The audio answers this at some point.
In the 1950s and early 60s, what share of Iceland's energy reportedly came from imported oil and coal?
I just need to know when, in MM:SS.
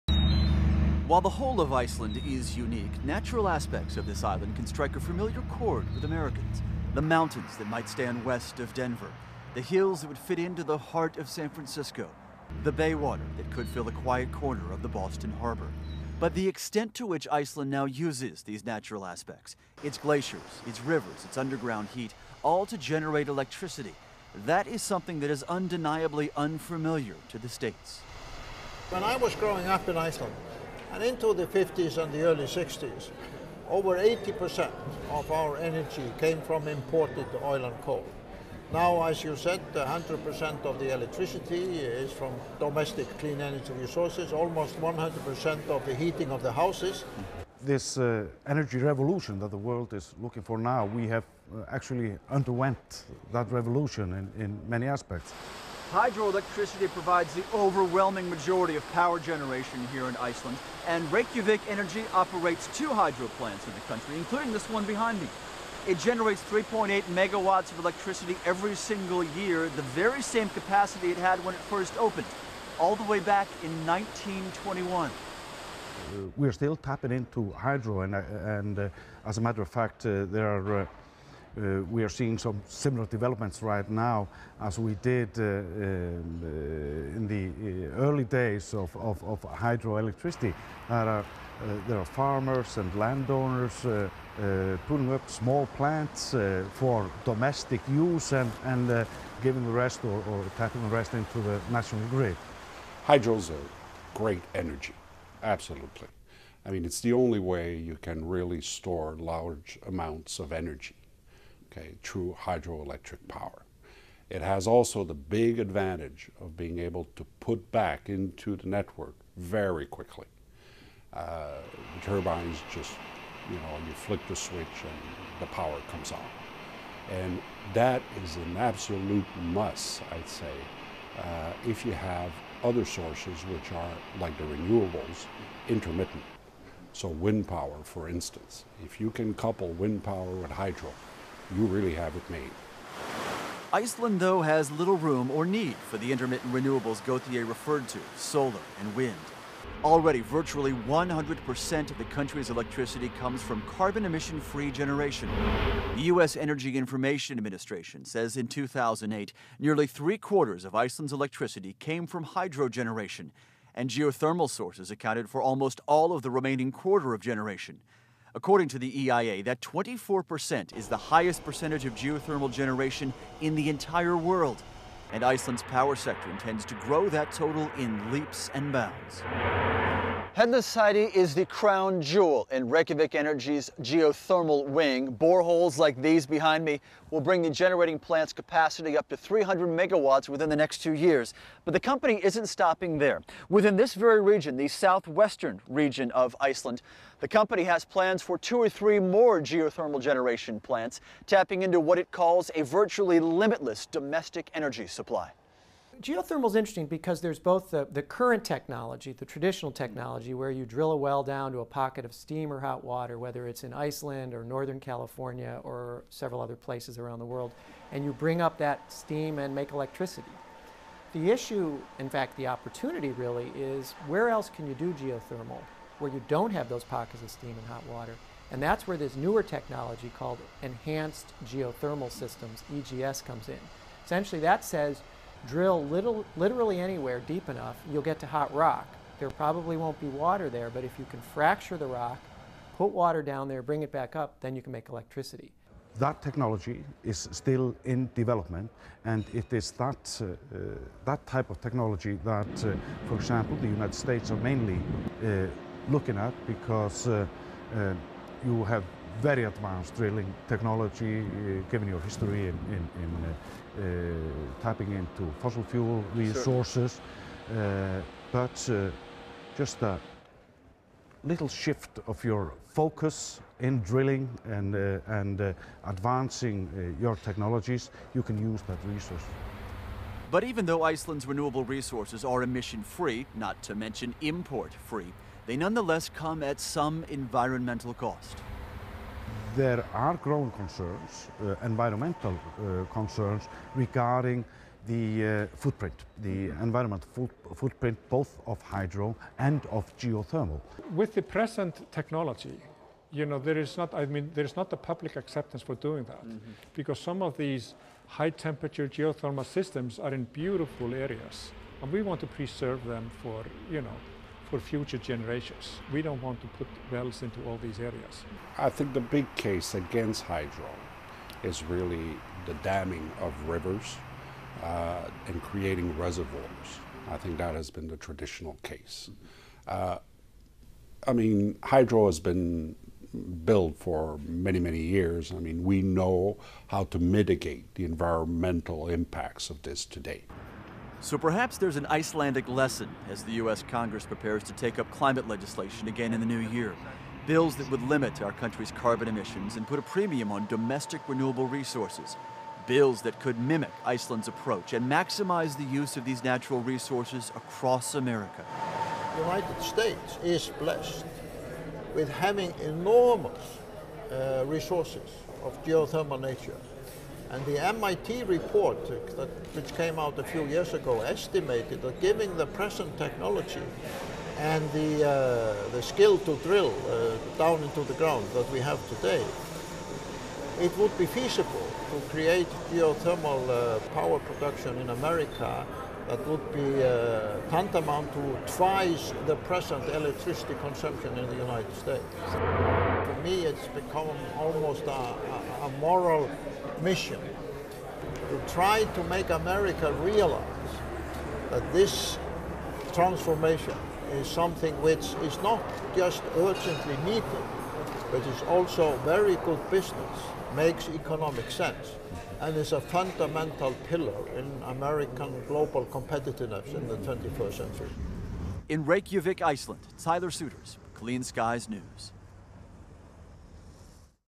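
00:33.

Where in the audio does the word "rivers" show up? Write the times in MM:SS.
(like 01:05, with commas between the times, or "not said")
00:20, 05:23.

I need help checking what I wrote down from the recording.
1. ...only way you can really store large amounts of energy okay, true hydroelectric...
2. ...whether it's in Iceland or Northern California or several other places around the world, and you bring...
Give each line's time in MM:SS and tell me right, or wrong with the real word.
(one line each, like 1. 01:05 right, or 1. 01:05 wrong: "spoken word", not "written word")
1. 01:47 right
2. 03:33 right.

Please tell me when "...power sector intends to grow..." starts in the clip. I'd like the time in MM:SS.
02:55.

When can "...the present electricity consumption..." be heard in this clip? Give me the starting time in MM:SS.
06:29.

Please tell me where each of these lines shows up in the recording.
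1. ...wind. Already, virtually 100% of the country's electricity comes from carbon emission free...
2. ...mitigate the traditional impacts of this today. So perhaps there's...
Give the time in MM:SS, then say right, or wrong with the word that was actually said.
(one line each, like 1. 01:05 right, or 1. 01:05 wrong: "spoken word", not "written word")
1. 02:28 right
2. 05:36 wrong: "environmental", not "traditional".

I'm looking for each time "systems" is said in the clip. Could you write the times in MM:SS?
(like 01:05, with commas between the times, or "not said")
03:52, 05:09.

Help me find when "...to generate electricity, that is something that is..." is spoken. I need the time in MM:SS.
00:22.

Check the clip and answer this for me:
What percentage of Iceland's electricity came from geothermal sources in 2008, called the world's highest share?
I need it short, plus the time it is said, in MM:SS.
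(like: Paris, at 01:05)
24%, at 02:49.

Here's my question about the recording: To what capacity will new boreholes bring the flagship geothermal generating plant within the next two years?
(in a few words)
300 megawatts.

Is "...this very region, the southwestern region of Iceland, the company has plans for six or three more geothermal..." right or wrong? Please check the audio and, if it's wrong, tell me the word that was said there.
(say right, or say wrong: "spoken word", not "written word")
wrong: "two", not "six".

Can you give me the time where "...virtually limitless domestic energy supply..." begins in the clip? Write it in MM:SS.
03:22.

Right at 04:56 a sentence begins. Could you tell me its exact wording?
environmental foot footprint both of hydro and of geothermal.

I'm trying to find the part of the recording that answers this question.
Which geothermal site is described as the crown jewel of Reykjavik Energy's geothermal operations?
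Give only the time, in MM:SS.
03:00.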